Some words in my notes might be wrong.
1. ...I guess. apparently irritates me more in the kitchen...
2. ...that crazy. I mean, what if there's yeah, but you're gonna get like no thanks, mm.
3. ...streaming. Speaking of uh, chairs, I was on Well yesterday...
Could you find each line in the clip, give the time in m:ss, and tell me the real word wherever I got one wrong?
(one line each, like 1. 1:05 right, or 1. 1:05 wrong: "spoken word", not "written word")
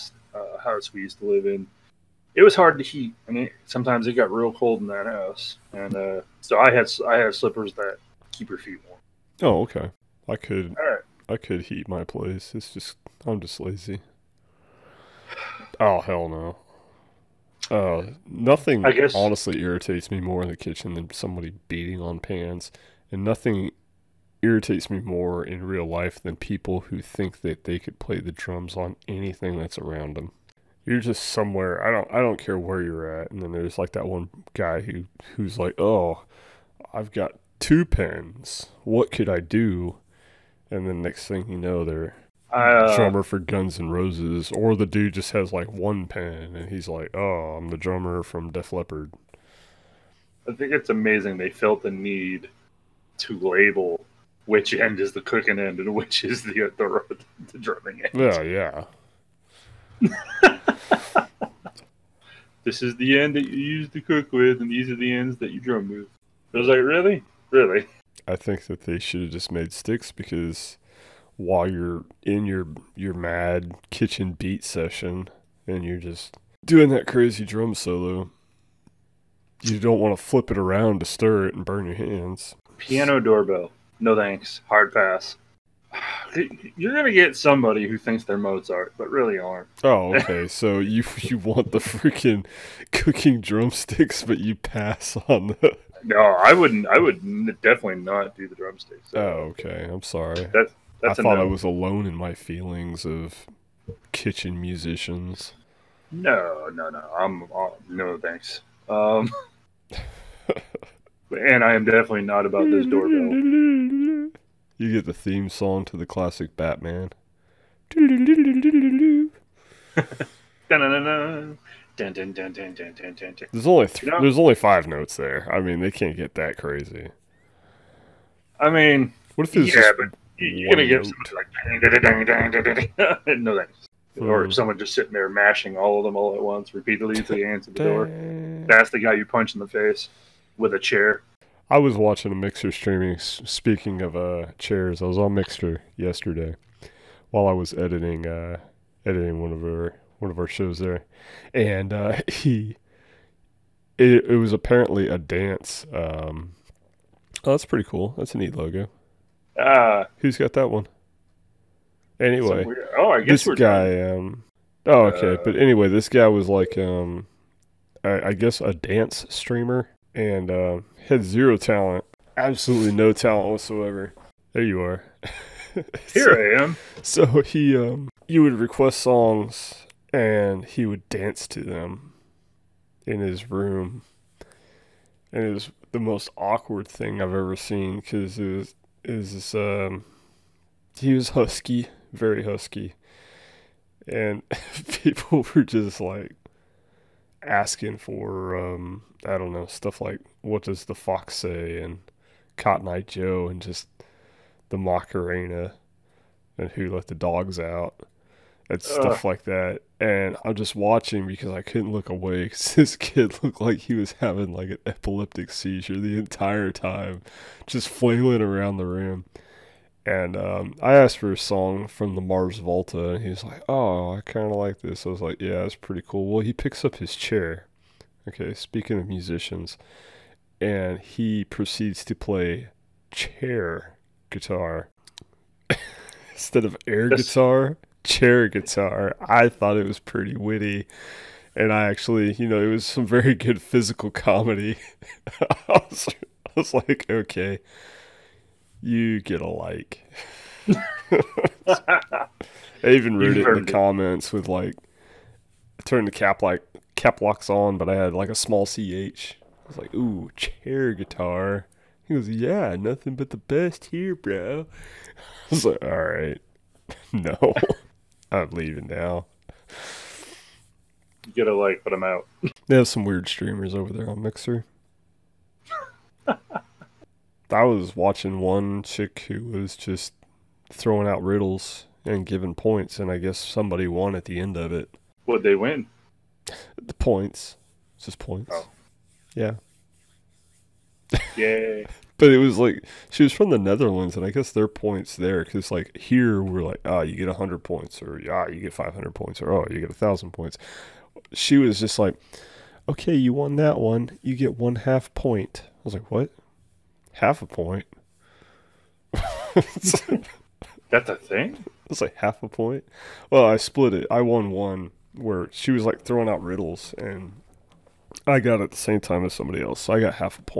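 1. 0:18 wrong: "honestly", not "apparently"
2. 2:06 right
3. 2:22 wrong: "Mixer", not "Well".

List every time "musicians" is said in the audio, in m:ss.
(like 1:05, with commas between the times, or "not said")
1:44, 3:49.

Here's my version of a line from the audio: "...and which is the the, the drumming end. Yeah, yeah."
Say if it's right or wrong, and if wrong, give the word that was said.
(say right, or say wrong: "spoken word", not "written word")
right.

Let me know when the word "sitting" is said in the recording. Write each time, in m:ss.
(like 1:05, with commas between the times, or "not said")
2:14.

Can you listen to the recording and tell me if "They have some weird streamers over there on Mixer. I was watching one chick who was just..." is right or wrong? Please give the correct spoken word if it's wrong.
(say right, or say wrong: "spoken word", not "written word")
right.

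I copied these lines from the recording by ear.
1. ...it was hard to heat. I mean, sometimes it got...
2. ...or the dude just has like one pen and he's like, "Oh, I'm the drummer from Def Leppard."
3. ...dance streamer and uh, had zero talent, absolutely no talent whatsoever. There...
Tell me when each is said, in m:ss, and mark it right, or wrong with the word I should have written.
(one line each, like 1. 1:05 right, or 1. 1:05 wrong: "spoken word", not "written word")
1. 0:02 right
2. 0:44 right
3. 2:48 right.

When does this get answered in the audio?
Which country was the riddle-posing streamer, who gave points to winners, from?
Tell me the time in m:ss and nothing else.
4:53.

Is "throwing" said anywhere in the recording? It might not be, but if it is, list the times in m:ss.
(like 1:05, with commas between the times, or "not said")
4:40, 5:16.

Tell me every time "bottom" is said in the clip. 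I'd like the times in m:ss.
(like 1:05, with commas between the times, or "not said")
not said.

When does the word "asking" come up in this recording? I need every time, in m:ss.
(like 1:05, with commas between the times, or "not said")
3:17.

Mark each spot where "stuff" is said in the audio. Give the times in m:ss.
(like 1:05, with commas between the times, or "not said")
3:19, 3:28.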